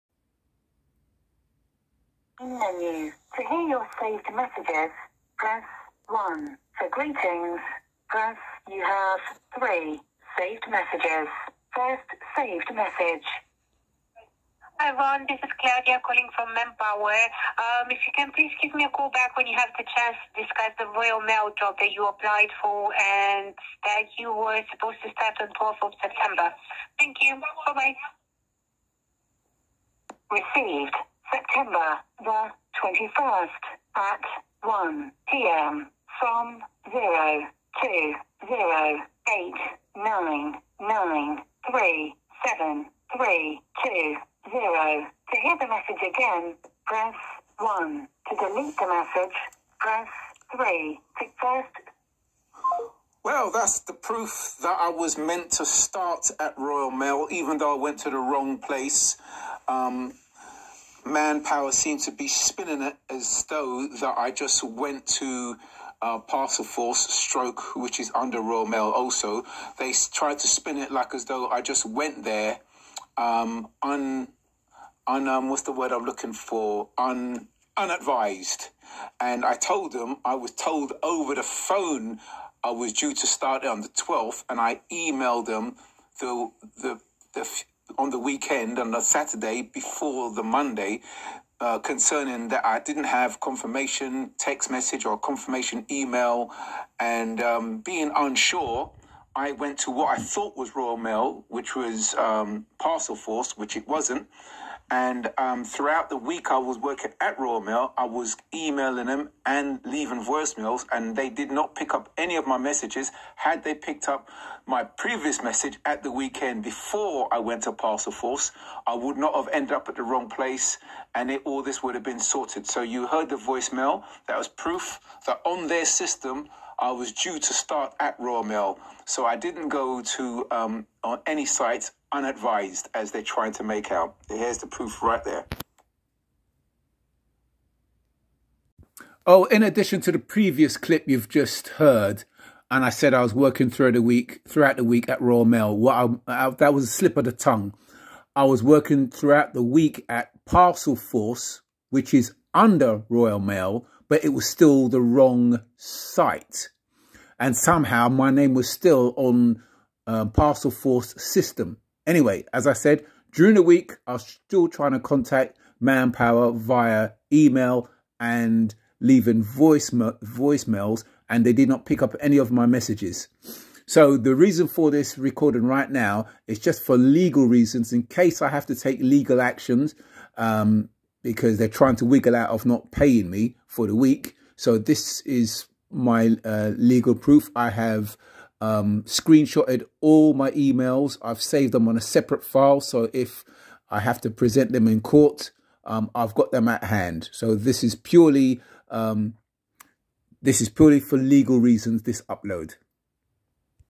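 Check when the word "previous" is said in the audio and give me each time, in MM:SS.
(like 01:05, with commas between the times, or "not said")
01:54, 02:20.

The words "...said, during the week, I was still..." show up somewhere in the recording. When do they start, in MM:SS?
02:42.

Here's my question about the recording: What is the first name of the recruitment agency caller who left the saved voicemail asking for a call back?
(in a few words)
Claudia.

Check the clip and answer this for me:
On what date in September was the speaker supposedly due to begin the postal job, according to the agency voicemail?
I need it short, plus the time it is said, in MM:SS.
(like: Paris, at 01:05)
12th of September, at 00:25.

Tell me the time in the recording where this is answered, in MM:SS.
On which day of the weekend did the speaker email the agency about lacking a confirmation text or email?
01:29.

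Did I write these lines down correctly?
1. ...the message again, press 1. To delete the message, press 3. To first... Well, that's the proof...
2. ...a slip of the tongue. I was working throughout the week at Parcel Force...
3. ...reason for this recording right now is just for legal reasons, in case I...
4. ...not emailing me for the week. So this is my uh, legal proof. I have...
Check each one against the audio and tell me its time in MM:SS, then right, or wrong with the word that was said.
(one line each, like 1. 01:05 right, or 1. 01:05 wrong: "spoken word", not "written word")
1. 00:45 right
2. 02:26 right
3. 02:54 right
4. 03:02 wrong: "paying", not "emailing".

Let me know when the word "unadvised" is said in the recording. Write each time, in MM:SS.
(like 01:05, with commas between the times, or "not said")
01:17, 02:12.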